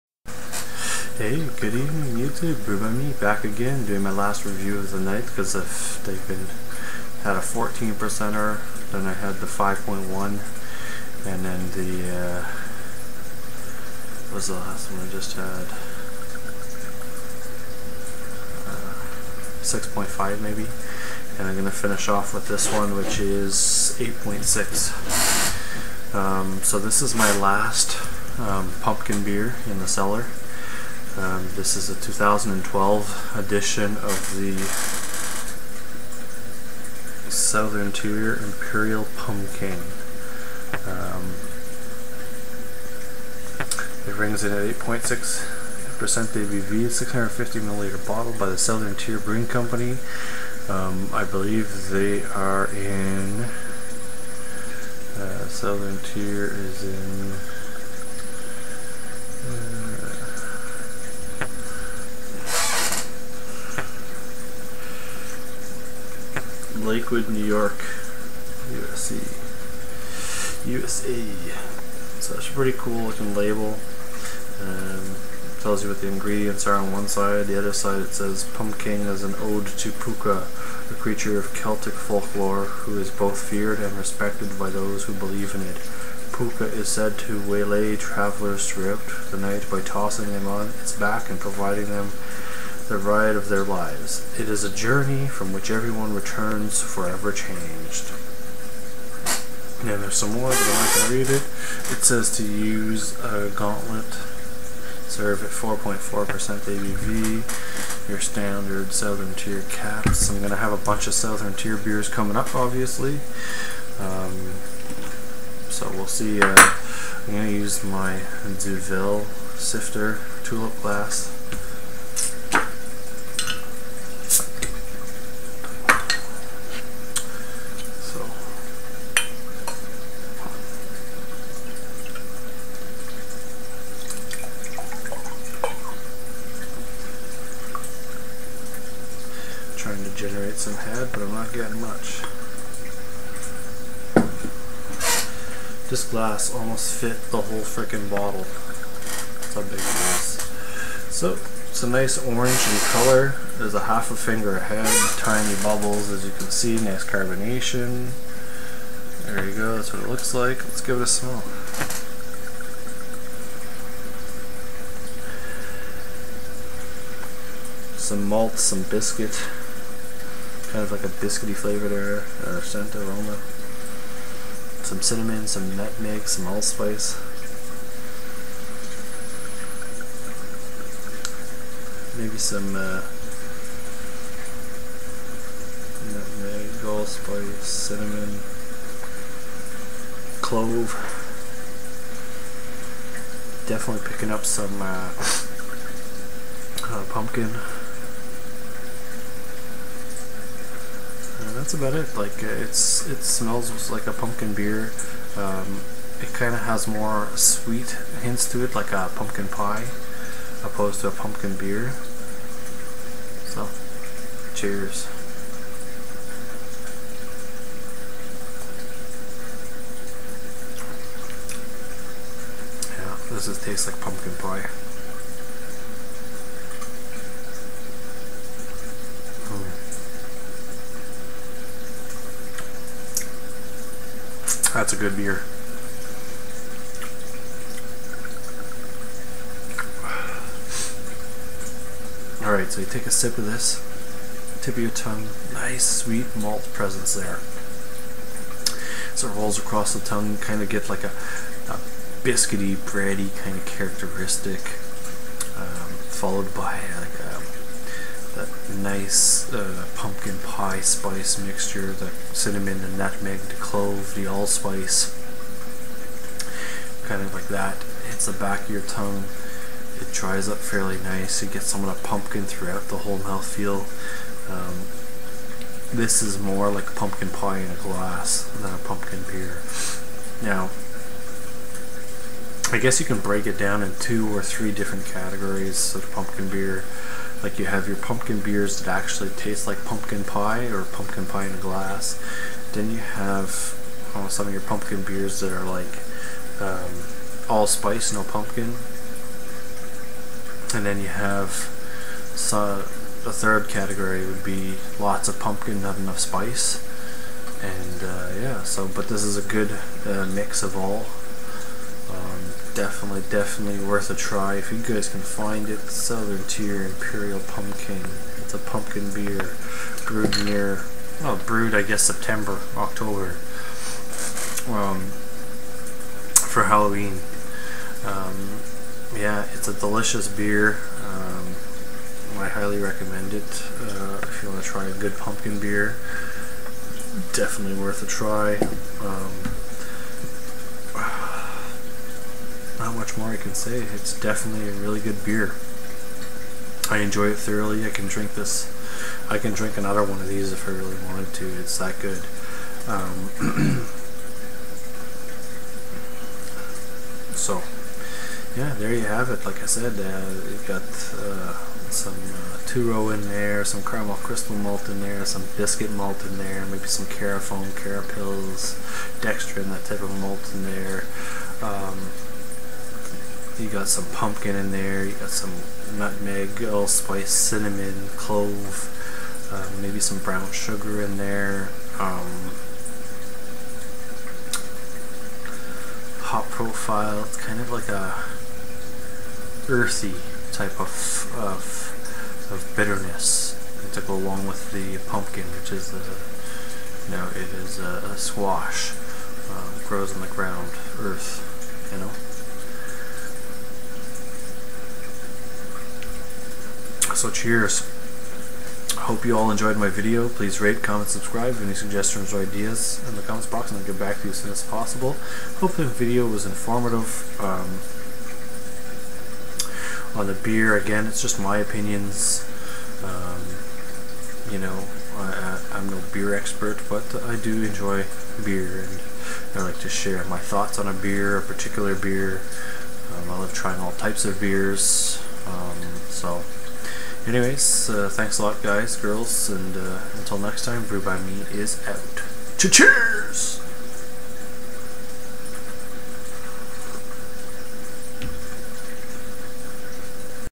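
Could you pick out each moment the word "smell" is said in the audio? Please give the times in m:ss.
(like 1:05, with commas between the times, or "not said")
2:41, 3:23.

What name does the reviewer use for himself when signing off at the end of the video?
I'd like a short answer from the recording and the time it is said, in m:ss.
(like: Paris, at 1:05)
Brew by Me, at 7:20.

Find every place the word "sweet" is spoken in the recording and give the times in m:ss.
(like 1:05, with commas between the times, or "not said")
3:27, 4:05.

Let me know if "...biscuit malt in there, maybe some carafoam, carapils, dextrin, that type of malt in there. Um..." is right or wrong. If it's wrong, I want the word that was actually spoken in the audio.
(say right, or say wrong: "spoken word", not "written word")
right.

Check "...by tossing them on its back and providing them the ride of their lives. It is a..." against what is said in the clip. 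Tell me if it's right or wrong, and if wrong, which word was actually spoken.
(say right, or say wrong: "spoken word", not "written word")
right.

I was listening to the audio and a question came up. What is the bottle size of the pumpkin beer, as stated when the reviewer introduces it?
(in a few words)
650 milliliters.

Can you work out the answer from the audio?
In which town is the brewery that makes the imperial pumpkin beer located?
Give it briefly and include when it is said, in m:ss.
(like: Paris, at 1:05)
Lakewood, New York, at 1:06.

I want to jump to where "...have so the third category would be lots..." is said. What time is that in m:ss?
5:01.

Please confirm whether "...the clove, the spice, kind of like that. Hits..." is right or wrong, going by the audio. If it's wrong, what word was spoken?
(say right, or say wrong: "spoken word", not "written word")
wrong: "allspice", not "spice".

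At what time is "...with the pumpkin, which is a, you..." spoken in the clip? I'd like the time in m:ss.
6:34.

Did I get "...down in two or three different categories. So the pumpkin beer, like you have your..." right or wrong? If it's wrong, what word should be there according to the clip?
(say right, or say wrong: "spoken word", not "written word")
right.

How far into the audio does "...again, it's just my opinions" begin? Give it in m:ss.
7:00.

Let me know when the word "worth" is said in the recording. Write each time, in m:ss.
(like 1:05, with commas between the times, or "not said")
5:13, 5:37.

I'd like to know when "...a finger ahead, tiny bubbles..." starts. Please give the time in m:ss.
2:34.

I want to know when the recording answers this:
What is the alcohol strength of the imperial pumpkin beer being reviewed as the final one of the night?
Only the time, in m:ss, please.
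0:44.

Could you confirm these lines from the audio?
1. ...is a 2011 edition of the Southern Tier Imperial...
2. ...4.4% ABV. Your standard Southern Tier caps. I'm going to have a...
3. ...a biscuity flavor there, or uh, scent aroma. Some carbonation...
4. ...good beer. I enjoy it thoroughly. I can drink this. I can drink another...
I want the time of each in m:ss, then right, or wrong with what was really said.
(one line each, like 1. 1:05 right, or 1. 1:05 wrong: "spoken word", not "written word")
1. 0:31 wrong: "2012", not "2011"
2. 1:45 right
3. 2:51 wrong: "cinnamon", not "carbonation"
4. 5:44 right.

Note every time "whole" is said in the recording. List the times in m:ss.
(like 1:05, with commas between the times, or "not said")
2:27, 4:32.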